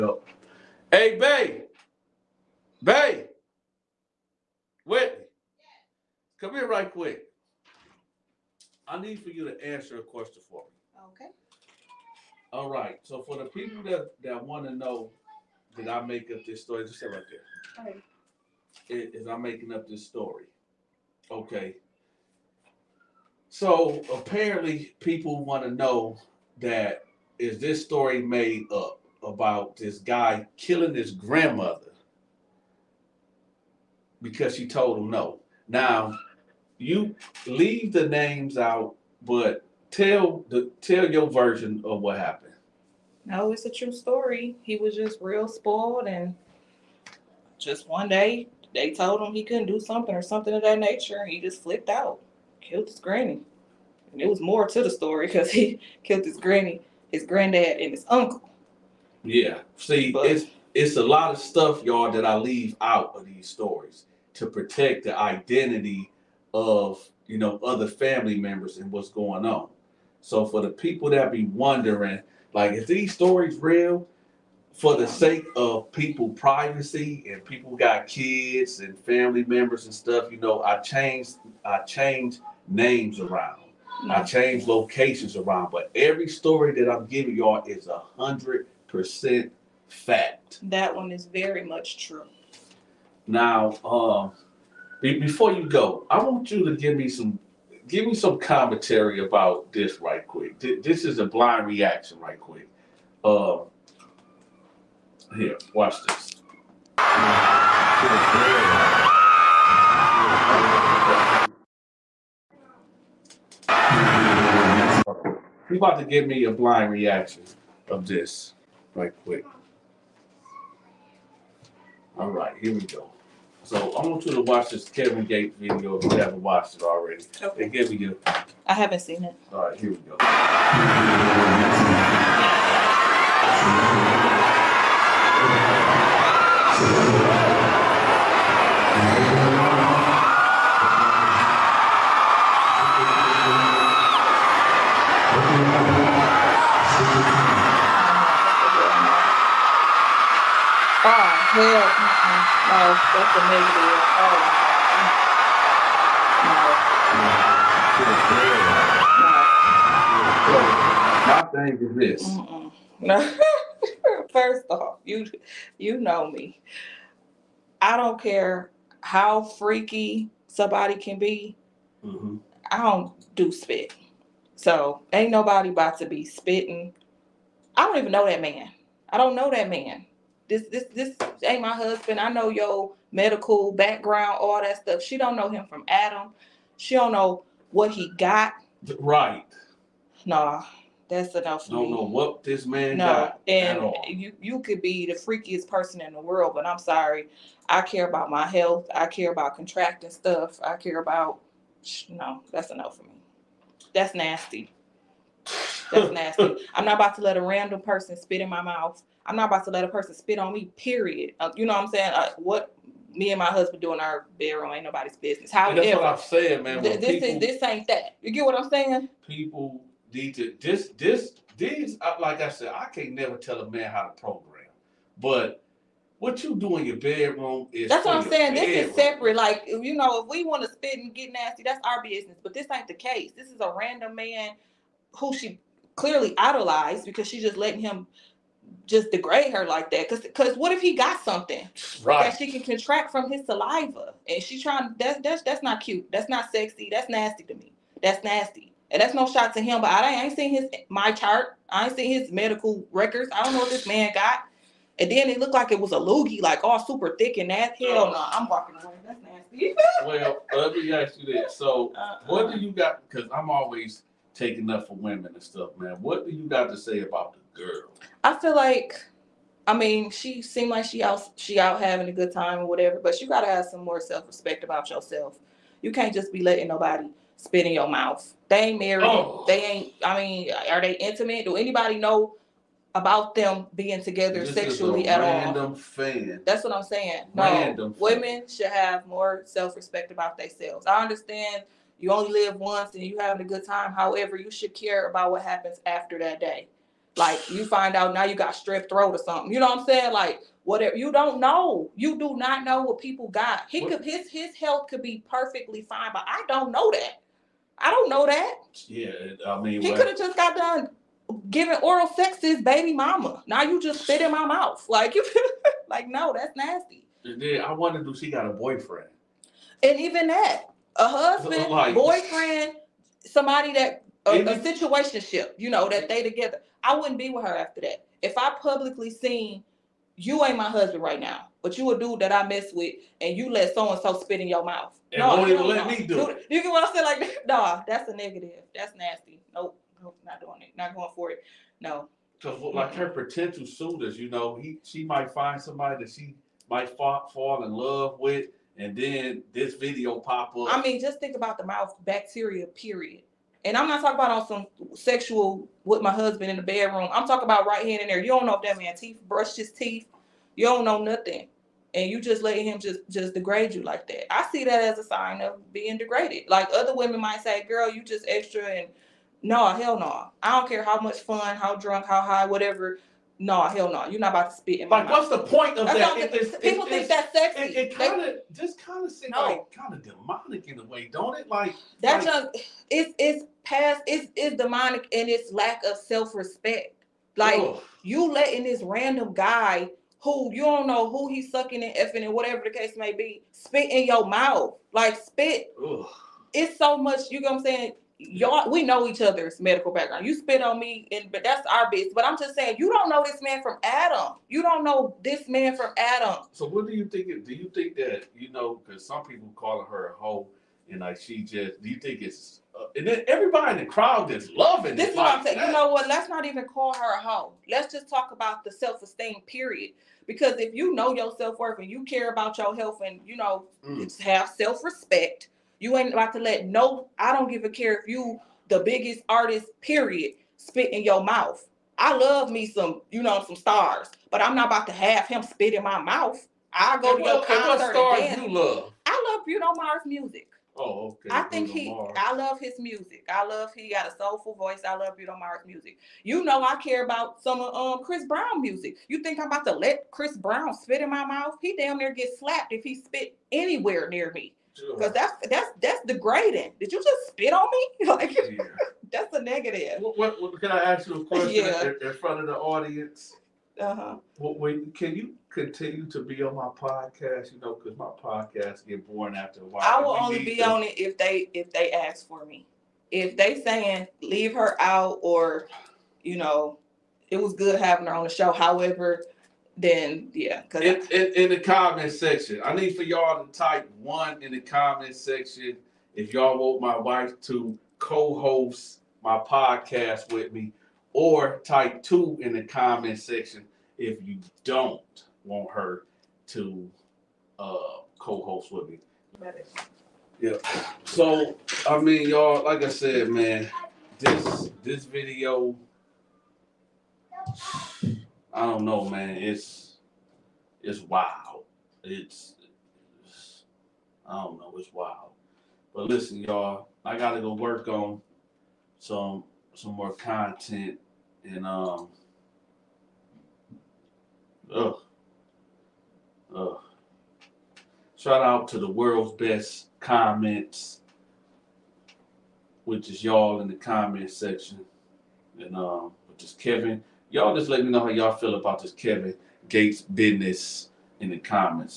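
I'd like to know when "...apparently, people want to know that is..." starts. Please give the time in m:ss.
0:24.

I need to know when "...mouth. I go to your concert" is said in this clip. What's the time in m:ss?
7:16.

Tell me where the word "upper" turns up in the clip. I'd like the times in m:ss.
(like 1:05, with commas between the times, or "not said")
not said.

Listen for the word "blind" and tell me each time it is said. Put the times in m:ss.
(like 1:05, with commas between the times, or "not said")
1:41, 1:56.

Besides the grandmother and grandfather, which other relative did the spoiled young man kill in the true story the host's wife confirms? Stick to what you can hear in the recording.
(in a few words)
His uncle.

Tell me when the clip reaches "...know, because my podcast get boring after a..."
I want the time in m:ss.
7:47.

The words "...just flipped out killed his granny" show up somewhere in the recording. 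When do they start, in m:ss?
0:51.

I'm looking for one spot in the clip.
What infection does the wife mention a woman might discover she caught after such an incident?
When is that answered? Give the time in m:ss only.
4:58.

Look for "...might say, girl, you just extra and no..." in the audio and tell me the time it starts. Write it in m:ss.
6:07.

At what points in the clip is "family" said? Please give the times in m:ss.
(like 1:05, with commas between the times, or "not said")
1:07, 1:18.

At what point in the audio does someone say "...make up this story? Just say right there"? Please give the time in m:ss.
0:16.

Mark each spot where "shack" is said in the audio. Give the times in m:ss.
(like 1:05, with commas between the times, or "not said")
not said.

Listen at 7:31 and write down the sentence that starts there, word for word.
He damn near gets slapped if he spit anywhere near me.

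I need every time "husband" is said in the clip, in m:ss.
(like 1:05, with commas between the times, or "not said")
3:01, 3:33, 5:21, 5:30, 5:56.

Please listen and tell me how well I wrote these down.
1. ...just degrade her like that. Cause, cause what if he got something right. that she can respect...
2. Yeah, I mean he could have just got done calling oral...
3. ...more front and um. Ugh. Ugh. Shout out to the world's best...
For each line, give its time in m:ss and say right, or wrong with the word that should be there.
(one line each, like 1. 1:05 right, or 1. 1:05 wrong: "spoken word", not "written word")
1. 3:58 wrong: "contract", not "respect"
2. 5:08 wrong: "giving", not "calling"
3. 8:39 wrong: "content", not "front".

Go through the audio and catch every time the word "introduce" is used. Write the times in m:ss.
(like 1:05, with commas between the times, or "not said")
not said.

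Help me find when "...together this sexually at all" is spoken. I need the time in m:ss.
4:44.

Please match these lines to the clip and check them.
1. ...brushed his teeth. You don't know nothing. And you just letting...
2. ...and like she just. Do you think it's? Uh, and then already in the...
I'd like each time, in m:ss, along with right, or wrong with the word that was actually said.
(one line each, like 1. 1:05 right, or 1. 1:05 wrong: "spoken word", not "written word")
1. 5:59 right
2. 6:50 wrong: "everybody", not "already".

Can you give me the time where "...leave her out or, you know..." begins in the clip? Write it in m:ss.
7:54.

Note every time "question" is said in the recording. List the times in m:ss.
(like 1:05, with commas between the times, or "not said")
0:10, 7:41.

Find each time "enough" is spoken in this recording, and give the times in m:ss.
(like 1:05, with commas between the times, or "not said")
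3:11, 3:22.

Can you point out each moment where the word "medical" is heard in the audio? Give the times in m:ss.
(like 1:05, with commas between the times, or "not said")
3:03, 4:12, 6:39.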